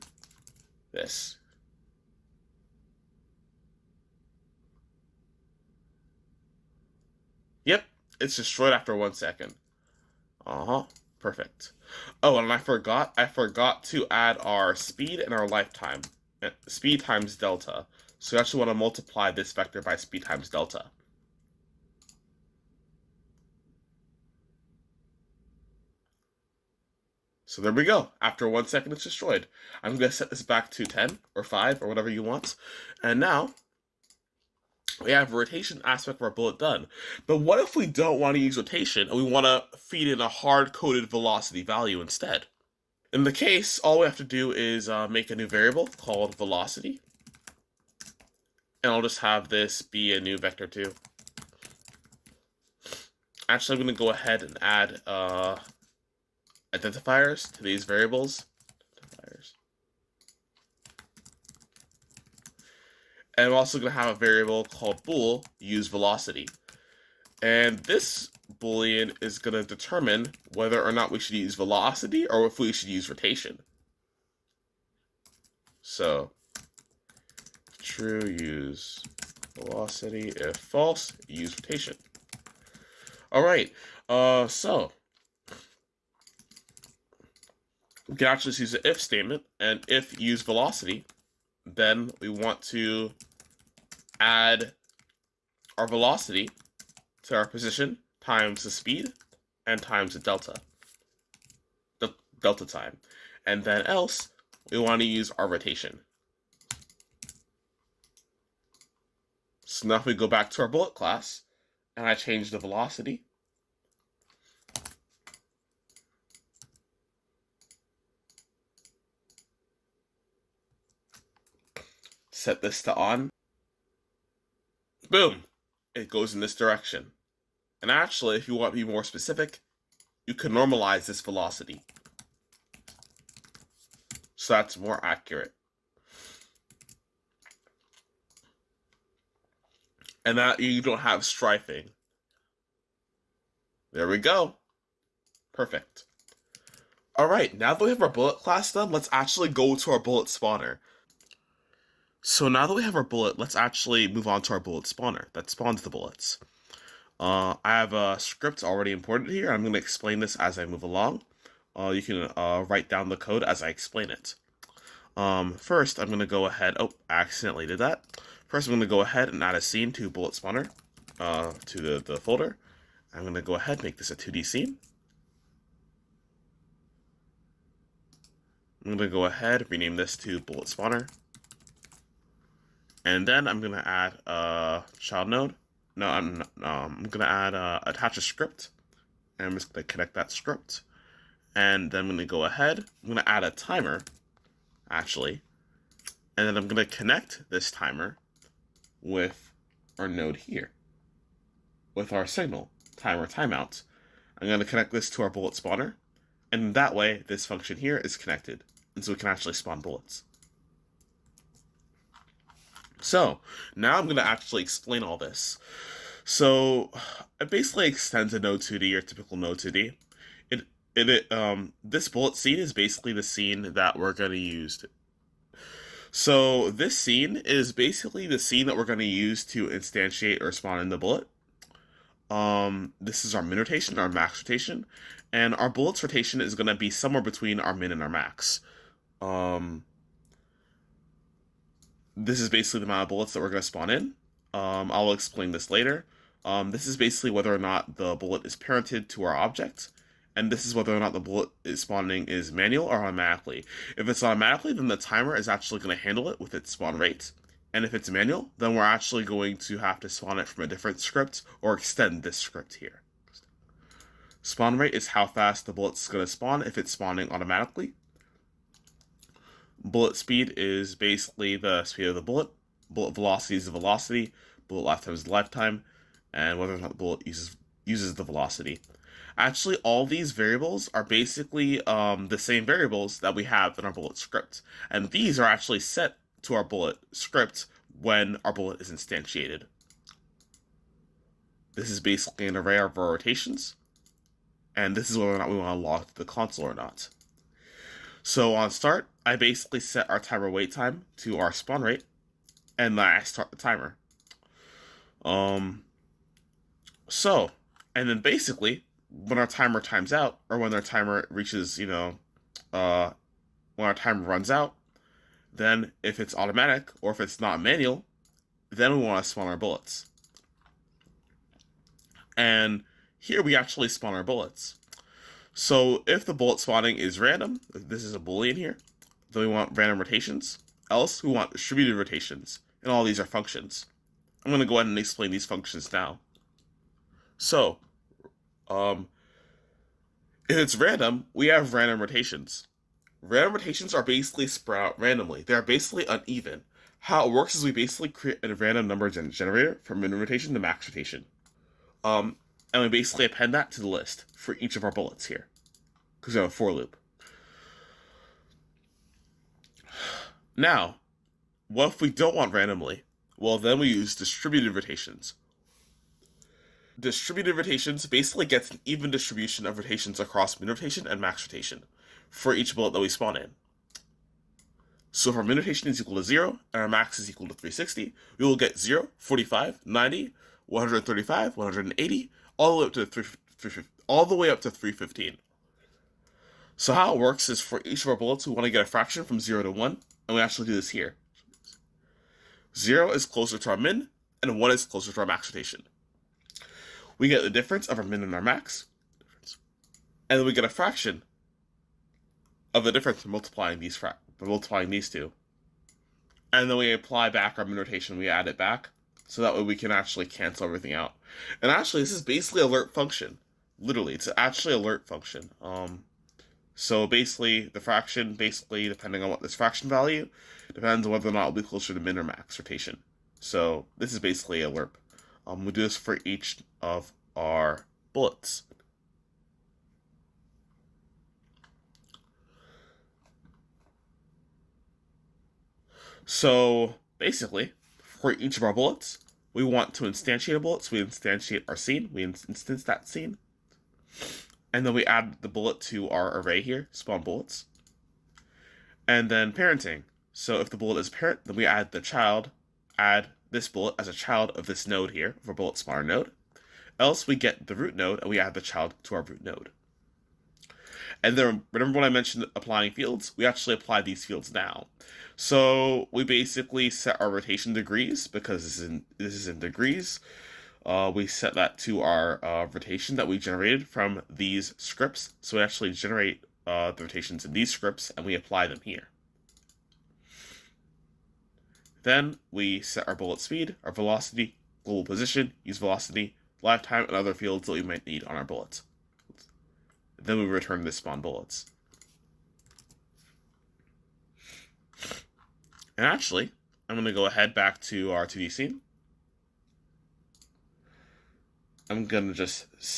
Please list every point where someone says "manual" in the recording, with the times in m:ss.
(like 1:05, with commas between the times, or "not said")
4:12, 4:18, 5:17.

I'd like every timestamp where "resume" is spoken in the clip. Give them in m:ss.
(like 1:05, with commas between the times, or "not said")
not said.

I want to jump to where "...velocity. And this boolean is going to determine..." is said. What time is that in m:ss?
1:05.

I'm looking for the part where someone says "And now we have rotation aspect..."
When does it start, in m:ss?
0:33.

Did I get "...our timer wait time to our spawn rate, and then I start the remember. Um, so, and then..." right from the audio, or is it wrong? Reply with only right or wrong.
wrong.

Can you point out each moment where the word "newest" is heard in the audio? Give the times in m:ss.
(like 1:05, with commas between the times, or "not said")
not said.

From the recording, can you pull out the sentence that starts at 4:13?
If it's automatically, then the timer is actually going to handle it with its spawn rate.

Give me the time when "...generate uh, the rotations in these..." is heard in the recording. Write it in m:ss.
7:55.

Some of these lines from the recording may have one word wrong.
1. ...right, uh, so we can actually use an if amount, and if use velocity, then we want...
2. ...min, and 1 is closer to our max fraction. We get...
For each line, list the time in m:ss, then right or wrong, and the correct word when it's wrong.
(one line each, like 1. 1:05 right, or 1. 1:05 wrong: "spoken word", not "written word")
1. 1:23 wrong: "statement", not "amount"
2. 6:33 wrong: "rotation", not "fraction".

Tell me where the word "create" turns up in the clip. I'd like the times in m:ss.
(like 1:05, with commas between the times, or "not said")
5:48.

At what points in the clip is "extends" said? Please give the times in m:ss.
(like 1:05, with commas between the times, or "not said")
3:37, 4:21.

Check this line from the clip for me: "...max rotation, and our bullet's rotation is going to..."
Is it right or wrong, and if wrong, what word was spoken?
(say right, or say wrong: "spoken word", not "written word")
right.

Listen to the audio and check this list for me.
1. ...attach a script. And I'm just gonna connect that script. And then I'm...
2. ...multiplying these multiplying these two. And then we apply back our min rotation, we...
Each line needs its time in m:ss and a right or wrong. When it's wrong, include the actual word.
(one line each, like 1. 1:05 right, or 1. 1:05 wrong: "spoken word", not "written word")
1. 3:07 right
2. 6:43 right.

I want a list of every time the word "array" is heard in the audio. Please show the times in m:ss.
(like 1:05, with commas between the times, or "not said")
4:52, 7:26.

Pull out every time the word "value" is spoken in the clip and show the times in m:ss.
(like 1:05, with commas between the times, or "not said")
0:41, 6:59.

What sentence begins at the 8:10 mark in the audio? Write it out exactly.
Then we return the spawn bullets.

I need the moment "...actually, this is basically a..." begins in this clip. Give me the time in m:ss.
6:51.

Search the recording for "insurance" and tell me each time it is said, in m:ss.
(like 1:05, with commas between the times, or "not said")
not said.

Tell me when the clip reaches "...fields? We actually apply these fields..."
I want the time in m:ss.
7:42.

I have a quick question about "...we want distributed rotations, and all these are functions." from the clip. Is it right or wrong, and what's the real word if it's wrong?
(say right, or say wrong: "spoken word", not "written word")
right.